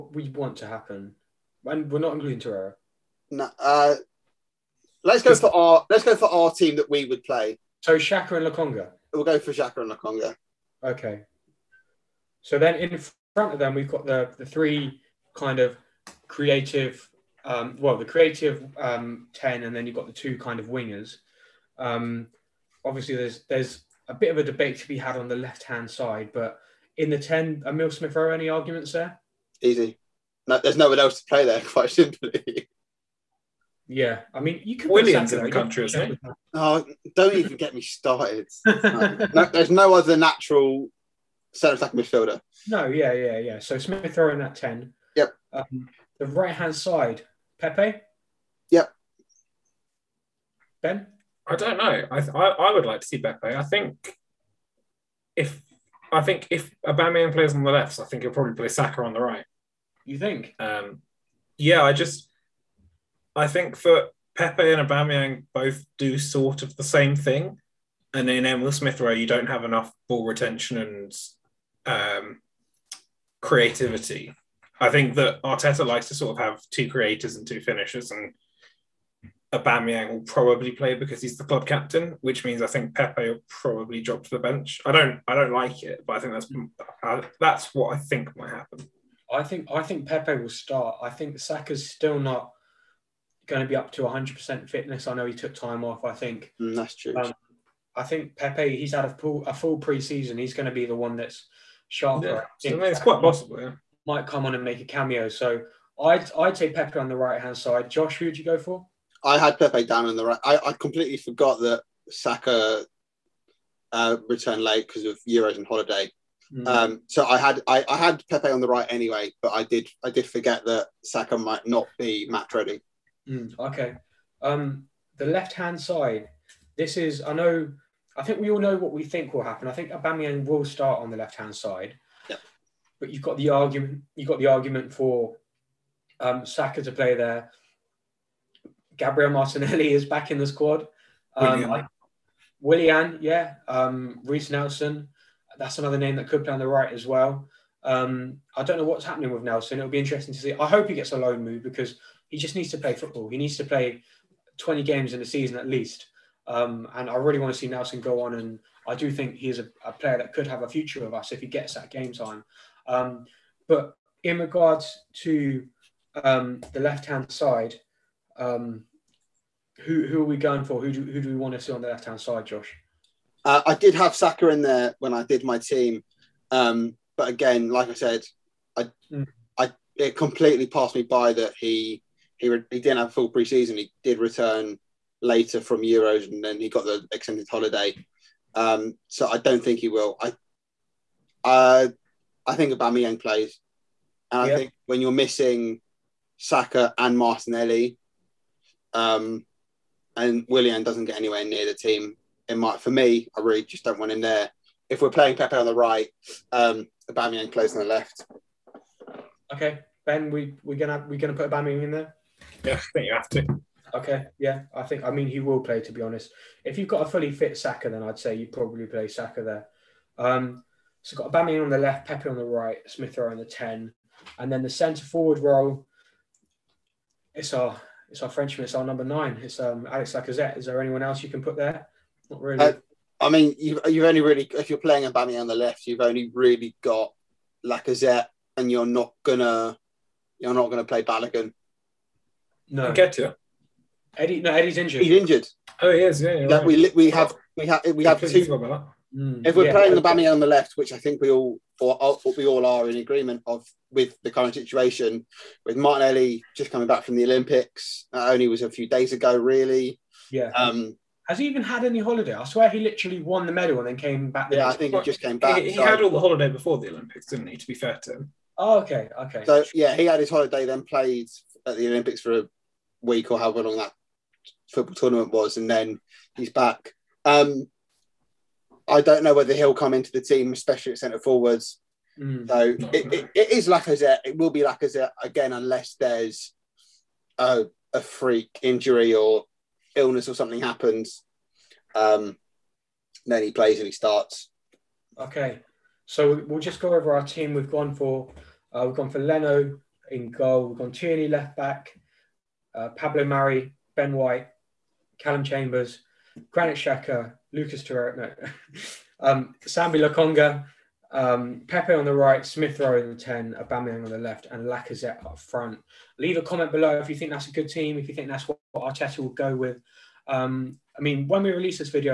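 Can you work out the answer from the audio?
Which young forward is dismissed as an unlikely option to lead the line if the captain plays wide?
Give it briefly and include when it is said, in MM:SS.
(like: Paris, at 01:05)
Balogun, at 04:01.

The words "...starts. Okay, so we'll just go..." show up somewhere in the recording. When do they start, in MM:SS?
04:53.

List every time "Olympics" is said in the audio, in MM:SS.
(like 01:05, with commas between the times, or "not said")
04:17, 04:26, 04:31.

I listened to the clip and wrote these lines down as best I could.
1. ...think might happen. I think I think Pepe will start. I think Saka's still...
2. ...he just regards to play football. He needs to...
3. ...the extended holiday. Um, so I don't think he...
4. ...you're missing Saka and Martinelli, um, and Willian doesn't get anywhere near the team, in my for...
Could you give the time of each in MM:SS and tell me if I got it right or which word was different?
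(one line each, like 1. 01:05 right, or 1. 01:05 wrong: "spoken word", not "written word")
1. 01:27 right
2. 02:32 wrong: "needs", not "regards"
3. 03:06 right
4. 03:14 right.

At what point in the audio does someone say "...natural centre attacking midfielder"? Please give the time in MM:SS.
00:40.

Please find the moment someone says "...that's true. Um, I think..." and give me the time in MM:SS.
01:36.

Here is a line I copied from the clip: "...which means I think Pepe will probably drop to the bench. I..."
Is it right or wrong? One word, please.
right.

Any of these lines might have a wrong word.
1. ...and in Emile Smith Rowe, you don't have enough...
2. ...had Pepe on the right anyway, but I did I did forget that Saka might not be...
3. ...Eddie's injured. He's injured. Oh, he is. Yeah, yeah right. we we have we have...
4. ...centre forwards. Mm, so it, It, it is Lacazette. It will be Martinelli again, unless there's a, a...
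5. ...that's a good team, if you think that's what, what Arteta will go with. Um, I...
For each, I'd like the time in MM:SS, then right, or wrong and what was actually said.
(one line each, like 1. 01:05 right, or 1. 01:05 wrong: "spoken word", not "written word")
1. 01:08 right
2. 01:57 right
3. 04:04 right
4. 04:40 wrong: "Lacazette", not "Martinelli"
5. 05:17 right.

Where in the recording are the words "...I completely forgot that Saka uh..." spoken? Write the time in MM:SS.
01:50.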